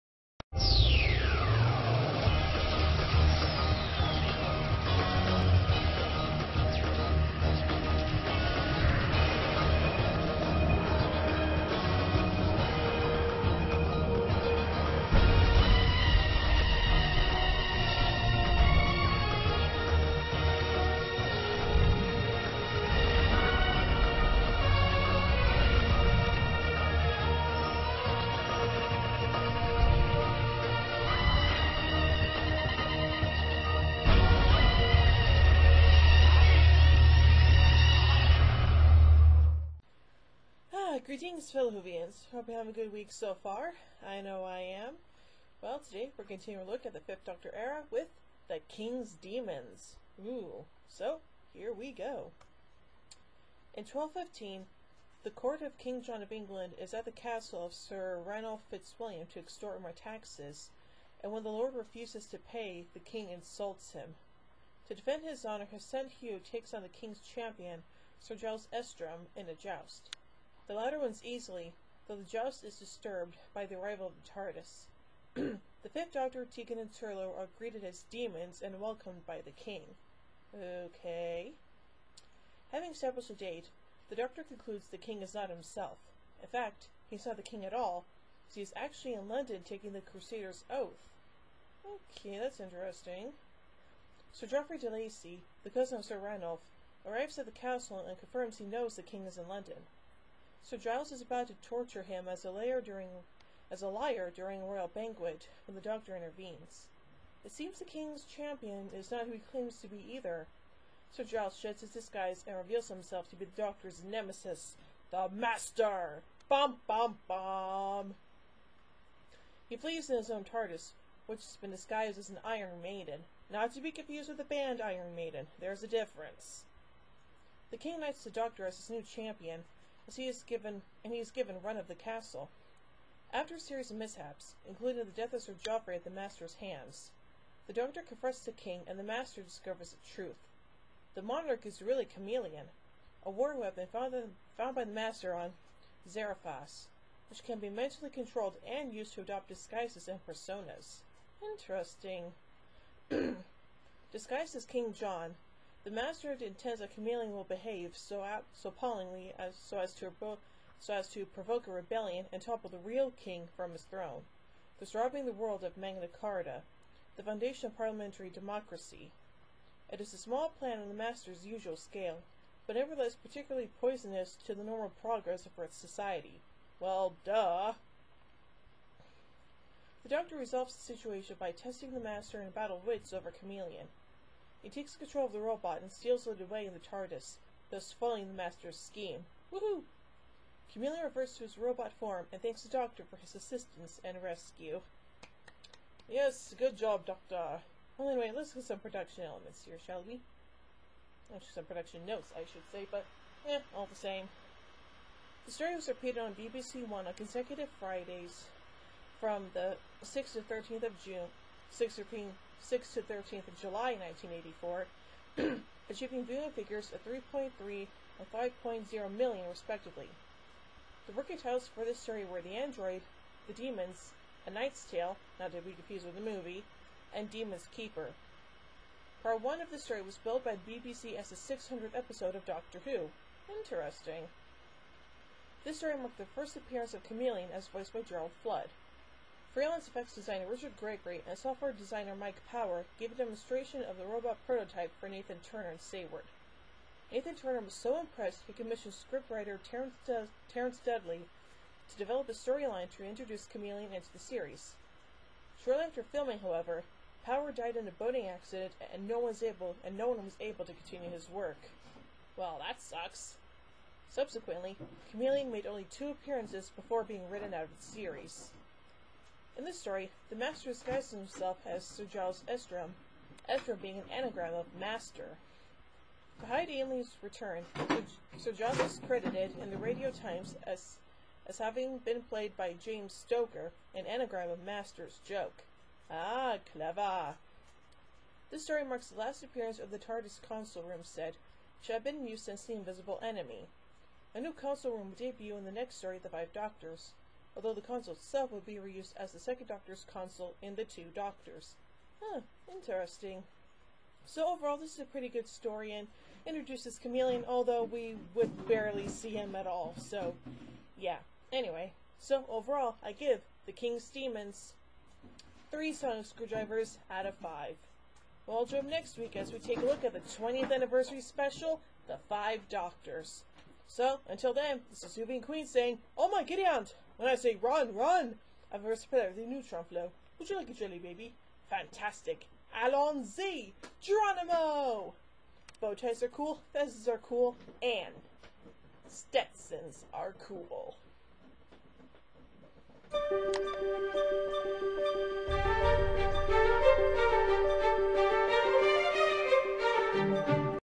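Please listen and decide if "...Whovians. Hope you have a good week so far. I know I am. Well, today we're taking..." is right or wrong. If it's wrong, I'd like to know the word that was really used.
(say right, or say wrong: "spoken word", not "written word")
wrong: "continuing", not "taking".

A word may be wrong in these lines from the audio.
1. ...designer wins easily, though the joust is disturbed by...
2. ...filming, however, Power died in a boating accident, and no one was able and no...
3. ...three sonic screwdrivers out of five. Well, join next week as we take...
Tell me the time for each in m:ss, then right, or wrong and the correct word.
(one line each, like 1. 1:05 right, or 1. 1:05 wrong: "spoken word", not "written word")
1. 1:10 wrong: "latter", not "designer"
2. 4:16 right
3. 5:15 right.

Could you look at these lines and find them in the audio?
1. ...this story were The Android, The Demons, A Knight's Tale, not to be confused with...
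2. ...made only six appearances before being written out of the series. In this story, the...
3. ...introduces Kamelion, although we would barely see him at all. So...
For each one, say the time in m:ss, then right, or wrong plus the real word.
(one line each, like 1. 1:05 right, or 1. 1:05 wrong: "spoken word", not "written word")
1. 3:41 right
2. 4:25 wrong: "two", not "six"
3. 5:06 right.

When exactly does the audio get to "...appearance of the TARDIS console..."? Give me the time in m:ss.
4:49.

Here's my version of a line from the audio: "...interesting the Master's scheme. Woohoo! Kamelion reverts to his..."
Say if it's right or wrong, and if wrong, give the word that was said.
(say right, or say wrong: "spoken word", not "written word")
wrong: "foiling", not "interesting".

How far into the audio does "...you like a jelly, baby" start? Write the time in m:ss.
5:30.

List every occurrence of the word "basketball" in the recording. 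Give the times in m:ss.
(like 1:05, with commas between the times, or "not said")
not said.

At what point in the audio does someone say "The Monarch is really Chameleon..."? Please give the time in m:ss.
2:21.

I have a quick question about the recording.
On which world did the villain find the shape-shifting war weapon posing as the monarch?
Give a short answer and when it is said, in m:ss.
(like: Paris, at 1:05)
Xeraphas, at 2:26.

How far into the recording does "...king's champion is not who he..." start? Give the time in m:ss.
1:47.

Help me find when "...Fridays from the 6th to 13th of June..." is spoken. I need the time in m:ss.
3:27.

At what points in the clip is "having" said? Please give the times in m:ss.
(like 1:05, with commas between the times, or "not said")
1:22, 4:41.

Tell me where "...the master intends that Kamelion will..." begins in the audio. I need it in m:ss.
2:35.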